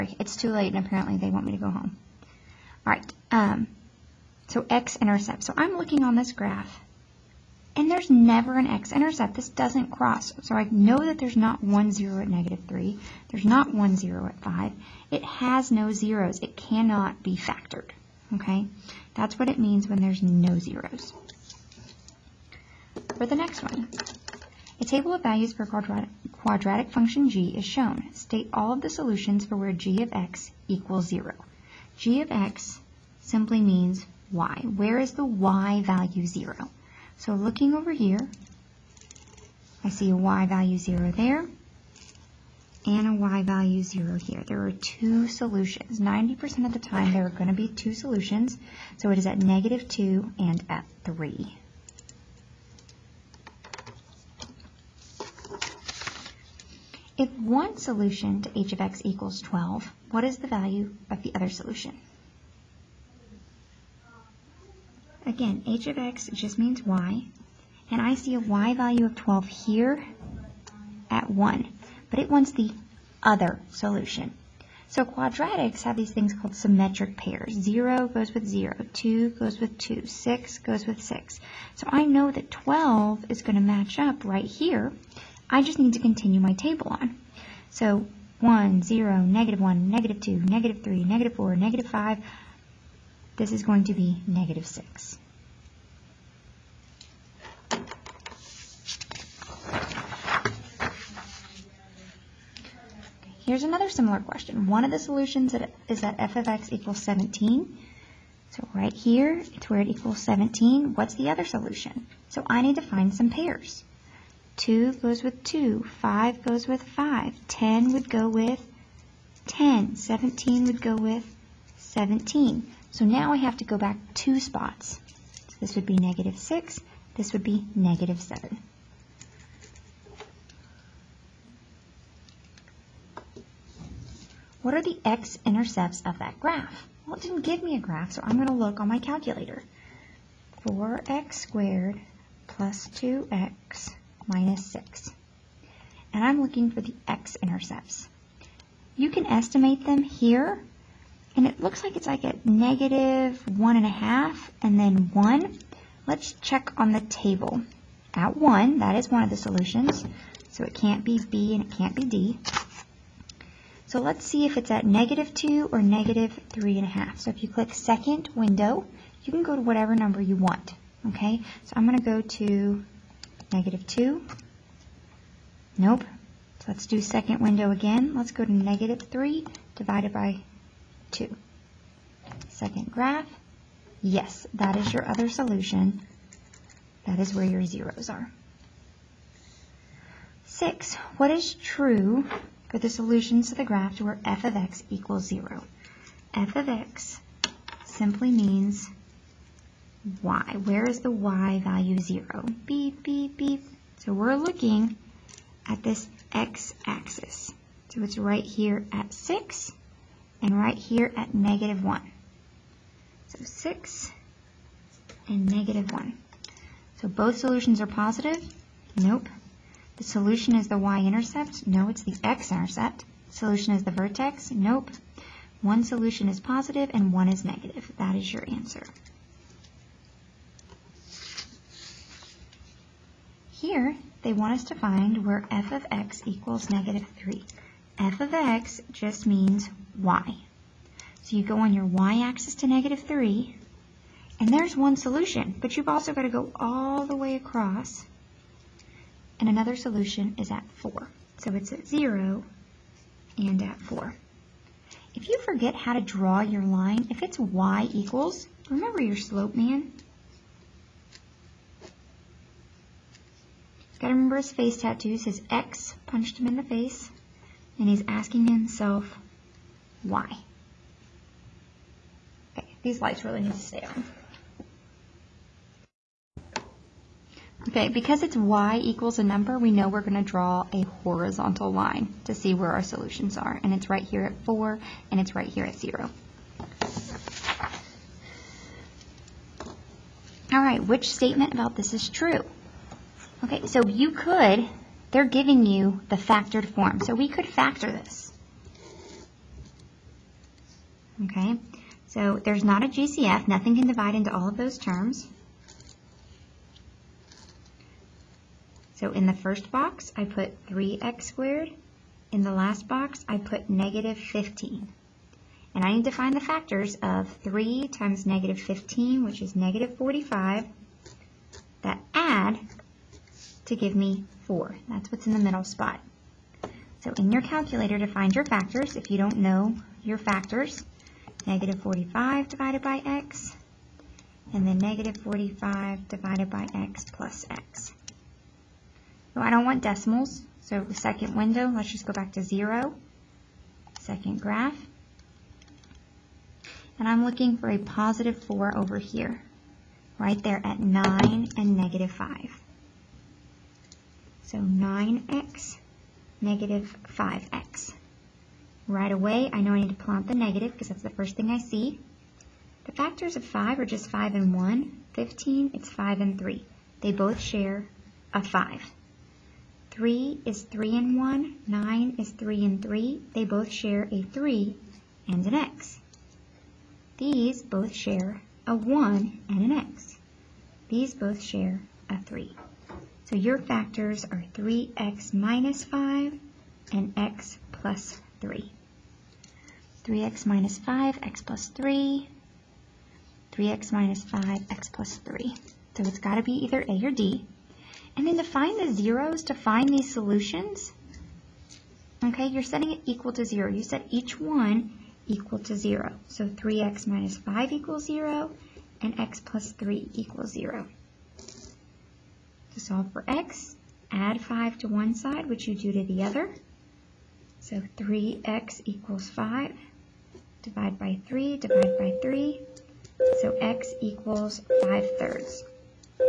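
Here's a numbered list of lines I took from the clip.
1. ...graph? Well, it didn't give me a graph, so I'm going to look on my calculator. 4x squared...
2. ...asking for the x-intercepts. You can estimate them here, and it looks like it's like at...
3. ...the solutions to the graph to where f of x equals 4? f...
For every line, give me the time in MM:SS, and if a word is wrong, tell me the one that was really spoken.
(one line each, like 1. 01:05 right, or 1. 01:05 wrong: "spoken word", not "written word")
1. 02:16 right
2. 02:26 wrong: "looking", not "asking"
3. 03:12 wrong: "0", not "4".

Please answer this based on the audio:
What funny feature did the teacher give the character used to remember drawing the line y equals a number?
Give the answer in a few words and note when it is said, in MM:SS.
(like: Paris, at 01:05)
face tattoos, at 04:24.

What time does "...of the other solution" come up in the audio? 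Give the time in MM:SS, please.
01:01.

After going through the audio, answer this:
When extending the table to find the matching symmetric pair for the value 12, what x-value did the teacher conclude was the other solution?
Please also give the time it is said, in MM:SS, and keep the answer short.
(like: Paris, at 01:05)
-6, at 01:34.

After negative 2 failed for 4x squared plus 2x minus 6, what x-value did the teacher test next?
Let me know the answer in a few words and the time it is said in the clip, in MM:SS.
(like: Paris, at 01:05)
-3/2, at 02:58.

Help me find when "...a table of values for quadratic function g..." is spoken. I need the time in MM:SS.
00:24.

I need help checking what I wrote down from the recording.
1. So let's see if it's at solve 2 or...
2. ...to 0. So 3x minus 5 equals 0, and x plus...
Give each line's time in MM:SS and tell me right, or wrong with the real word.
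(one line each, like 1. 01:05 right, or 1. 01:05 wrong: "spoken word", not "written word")
1. 02:43 wrong: "negative", not "solve"
2. 06:45 right.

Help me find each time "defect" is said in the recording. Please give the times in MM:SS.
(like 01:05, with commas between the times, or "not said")
not said.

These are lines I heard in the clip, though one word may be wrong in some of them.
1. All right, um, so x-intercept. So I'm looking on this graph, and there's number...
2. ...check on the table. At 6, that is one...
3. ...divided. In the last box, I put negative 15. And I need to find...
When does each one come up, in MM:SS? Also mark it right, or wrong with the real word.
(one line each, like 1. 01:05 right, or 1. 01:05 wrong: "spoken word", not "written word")
1. 00:02 wrong: "never", not "number"
2. 02:36 wrong: "1", not "6"
3. 05:11 wrong: "squared", not "divided".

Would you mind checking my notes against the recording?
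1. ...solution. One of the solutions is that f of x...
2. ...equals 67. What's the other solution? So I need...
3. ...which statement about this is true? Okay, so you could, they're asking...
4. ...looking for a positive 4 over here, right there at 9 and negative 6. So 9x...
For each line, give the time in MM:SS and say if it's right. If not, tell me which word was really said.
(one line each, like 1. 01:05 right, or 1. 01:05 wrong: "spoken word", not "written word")
1. 01:44 wrong: "question", not "solution"
2. 01:49 wrong: "17", not "67"
3. 04:50 wrong: "giving", not "asking"
4. 05:47 wrong: "5", not "6".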